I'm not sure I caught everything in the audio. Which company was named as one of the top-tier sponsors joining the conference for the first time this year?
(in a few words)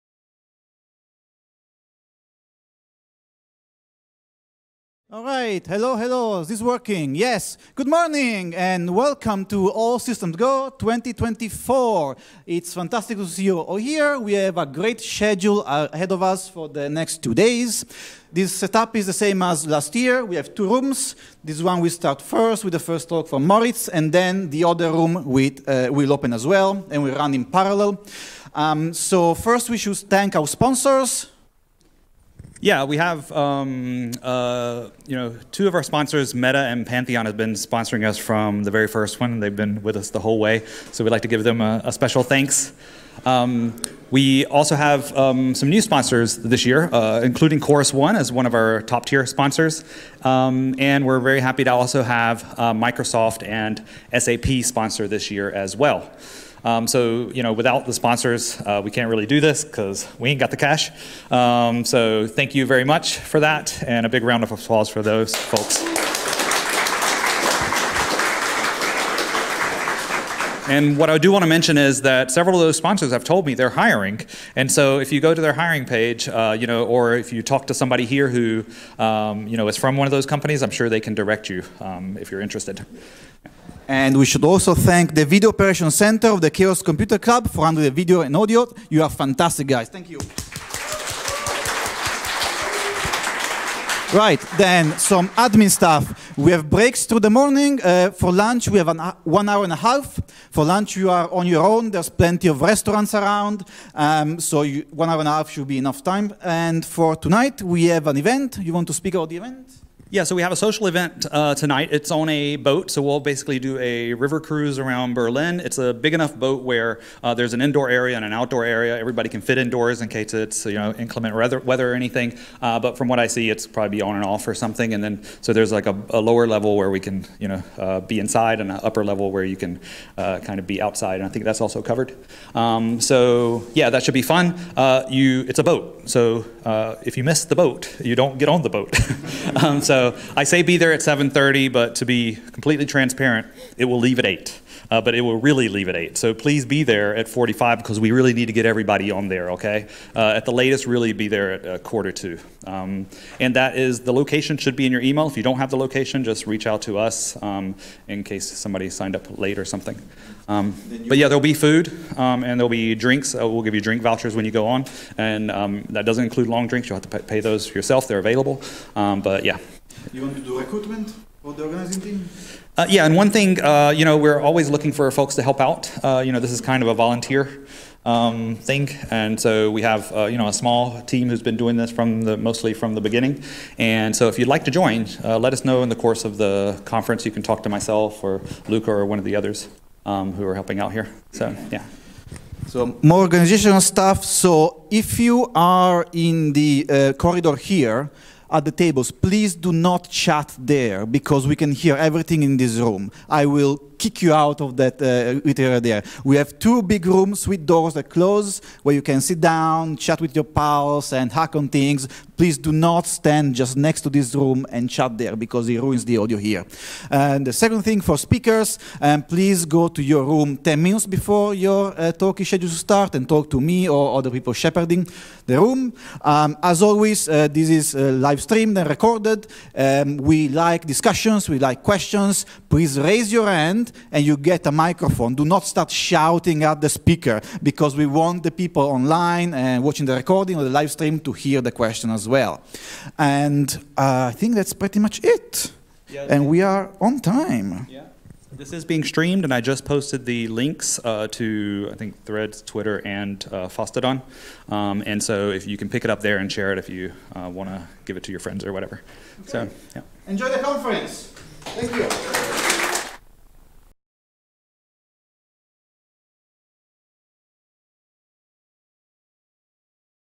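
Chorus One.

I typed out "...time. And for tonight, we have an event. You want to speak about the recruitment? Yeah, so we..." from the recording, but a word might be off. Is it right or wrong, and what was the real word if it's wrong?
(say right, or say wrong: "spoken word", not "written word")
wrong: "event", not "recruitment".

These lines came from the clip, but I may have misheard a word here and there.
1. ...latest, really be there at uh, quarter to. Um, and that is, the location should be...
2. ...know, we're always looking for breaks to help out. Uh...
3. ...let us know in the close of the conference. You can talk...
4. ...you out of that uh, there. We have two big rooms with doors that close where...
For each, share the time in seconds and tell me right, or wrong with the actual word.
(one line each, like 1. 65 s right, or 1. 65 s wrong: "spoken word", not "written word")
1. 150 s right
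2. 174 s wrong: "folks", not "breaks"
3. 185 s wrong: "course", not "close"
4. 204 s right.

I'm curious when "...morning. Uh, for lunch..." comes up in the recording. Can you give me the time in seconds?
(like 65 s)
97 s.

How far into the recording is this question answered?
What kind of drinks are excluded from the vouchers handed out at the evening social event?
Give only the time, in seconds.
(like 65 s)
166 s.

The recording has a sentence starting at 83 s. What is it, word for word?
And we should also thank the Video Operation Center of the Chaos Computer Club for handling the video and audio.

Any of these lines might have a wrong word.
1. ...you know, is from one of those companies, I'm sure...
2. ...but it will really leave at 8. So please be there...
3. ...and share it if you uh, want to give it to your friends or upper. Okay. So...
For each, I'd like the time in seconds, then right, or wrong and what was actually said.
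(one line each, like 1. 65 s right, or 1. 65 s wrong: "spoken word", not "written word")
1. 79 s right
2. 144 s right
3. 256 s wrong: "whatever", not "upper".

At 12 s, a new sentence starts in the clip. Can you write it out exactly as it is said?
It's fantastic to see you all here.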